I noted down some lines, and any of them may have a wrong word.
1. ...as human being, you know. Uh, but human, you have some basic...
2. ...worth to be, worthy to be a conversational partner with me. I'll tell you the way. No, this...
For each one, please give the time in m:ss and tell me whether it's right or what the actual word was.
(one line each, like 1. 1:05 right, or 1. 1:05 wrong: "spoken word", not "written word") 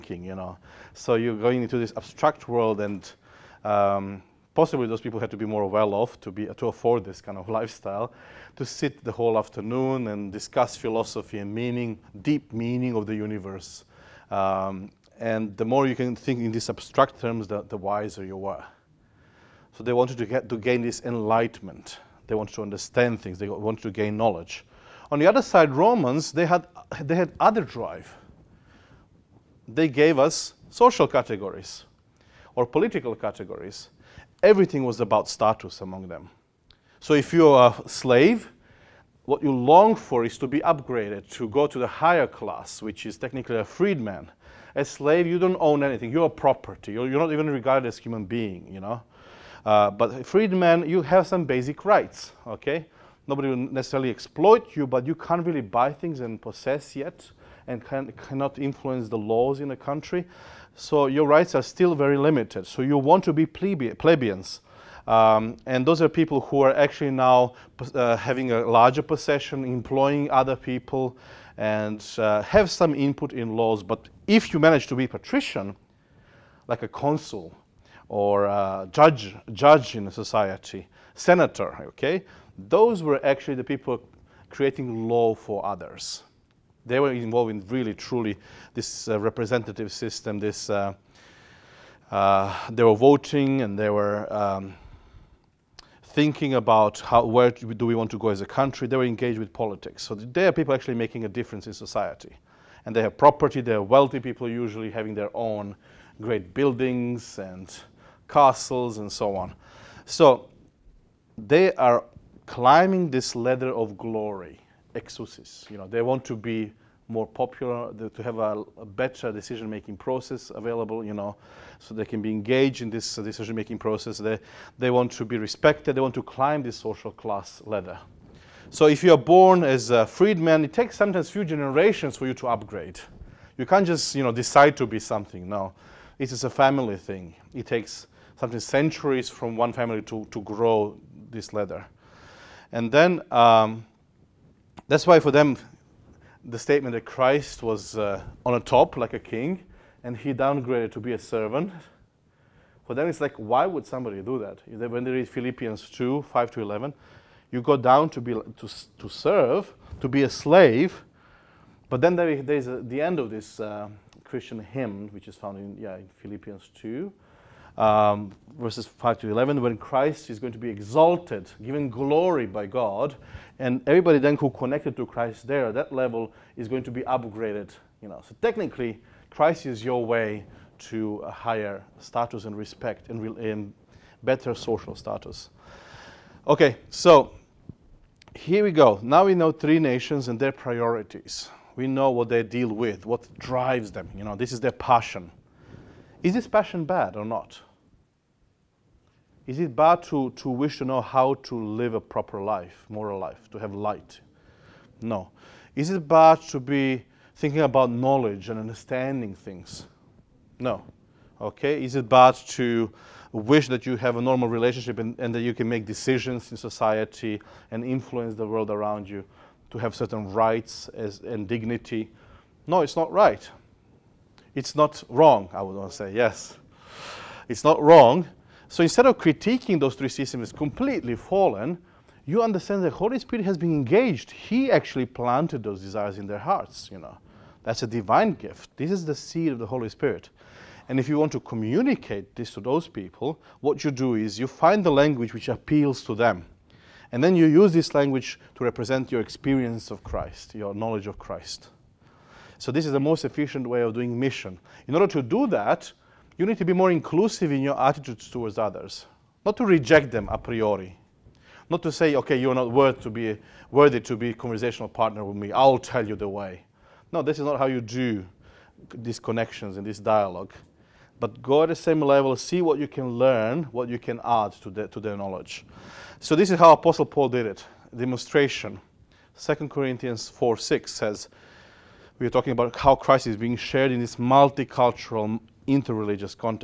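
1. 0:47 wrong: "freedman", not "human"
2. 4:22 right.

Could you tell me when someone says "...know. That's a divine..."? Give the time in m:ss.
3:56.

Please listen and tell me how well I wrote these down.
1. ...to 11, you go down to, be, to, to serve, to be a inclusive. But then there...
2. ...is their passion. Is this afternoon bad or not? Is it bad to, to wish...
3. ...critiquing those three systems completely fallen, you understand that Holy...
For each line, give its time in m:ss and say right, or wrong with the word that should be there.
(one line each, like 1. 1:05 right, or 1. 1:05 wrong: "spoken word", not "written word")
1. 2:36 wrong: "slave", not "inclusive"
2. 3:14 wrong: "passion", not "afternoon"
3. 3:49 right.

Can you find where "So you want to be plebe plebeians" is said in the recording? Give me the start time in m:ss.
1:02.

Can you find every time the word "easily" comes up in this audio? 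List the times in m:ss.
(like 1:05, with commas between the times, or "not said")
not said.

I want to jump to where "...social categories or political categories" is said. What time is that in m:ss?
0:30.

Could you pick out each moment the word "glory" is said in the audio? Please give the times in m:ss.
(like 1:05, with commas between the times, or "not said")
1:53, 2:51.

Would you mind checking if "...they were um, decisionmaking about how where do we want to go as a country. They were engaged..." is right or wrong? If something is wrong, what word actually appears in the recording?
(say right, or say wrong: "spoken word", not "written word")
wrong: "thinking", not "decisionmaking".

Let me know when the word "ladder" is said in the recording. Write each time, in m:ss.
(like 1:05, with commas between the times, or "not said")
1:53, 2:07, 2:21.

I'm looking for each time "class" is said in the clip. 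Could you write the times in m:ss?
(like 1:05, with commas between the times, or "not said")
0:42, 2:07.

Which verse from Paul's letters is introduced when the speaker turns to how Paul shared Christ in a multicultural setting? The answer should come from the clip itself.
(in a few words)
2 Corinthians 4:6.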